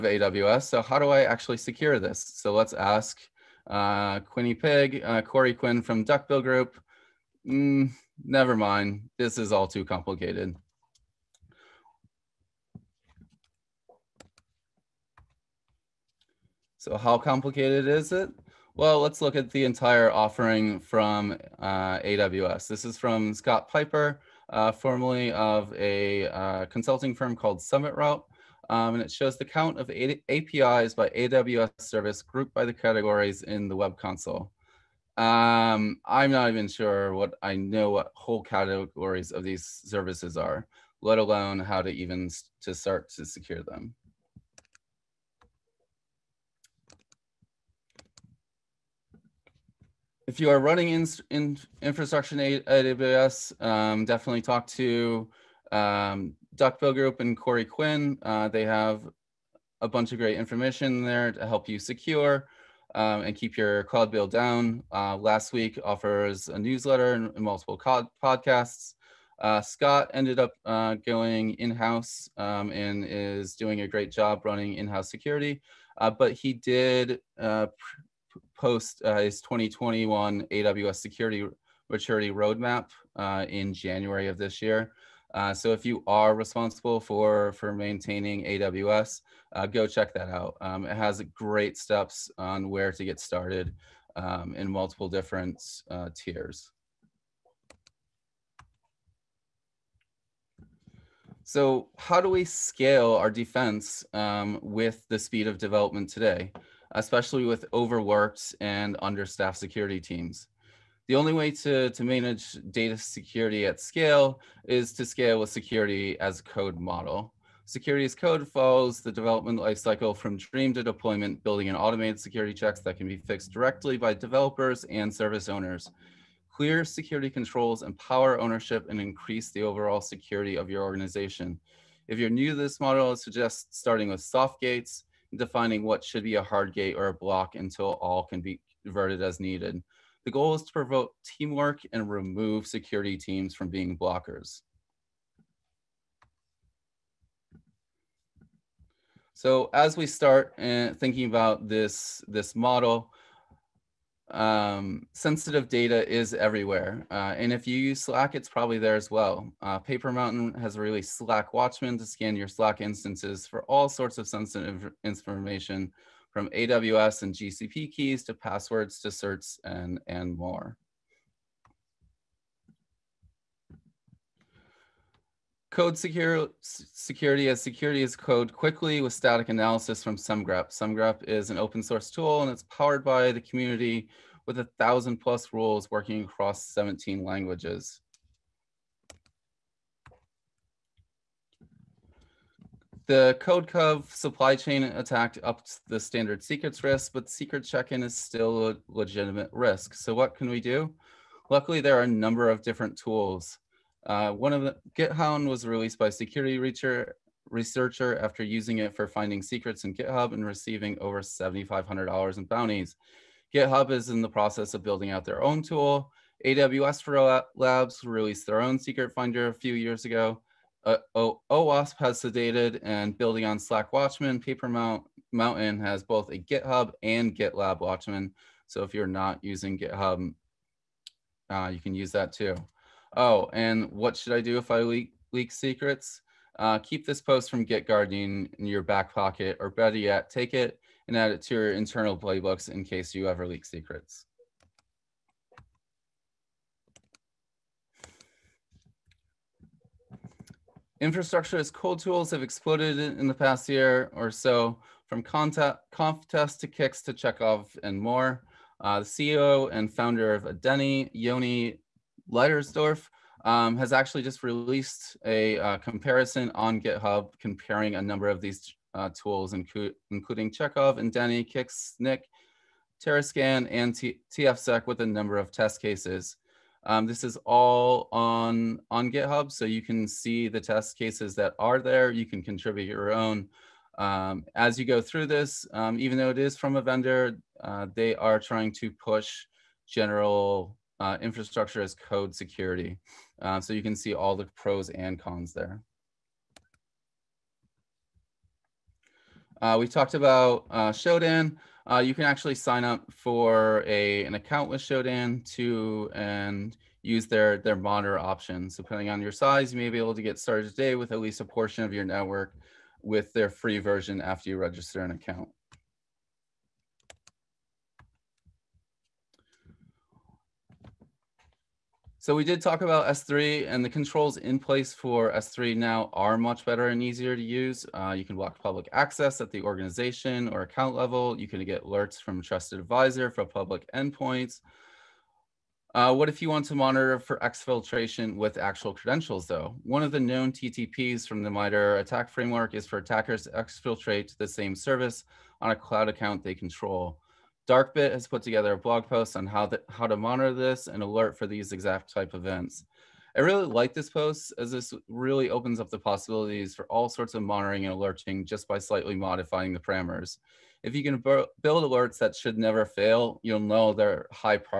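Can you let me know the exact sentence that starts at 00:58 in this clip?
Uh, they have a bunch of great information there to help you secure um, and keep your cloud bill down.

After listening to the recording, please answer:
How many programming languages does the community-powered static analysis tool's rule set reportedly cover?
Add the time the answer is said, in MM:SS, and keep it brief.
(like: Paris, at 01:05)
17, at 03:06.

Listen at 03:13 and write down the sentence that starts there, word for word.
The CodeCov supply chain attack upped the standard secrets risk, but secret check-in is still a legitimate risk.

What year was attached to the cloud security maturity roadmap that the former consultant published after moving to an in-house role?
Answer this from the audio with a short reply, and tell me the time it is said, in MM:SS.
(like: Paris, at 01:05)
2021, at 01:19.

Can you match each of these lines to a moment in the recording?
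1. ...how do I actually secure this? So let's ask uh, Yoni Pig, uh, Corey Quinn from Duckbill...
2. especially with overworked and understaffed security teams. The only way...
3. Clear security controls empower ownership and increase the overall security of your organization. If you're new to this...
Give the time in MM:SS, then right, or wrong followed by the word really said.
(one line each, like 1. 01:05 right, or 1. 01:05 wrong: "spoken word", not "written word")
1. 00:00 wrong: "Quinny", not "Yoni"
2. 01:46 right
3. 02:06 right.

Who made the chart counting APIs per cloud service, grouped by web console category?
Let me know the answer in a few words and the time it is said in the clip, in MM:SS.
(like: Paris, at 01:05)
Scott Piper, at 00:23.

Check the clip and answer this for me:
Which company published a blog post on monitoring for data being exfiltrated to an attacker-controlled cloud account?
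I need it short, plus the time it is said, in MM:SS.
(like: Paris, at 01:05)
Darkbit, at 05:47.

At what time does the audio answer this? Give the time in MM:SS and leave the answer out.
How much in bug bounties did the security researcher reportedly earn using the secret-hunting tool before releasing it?
03:31.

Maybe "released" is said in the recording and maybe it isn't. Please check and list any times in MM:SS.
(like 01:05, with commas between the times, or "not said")
02:40, 03:25, 03:38, 04:24.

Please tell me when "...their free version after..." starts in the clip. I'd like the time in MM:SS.
05:13.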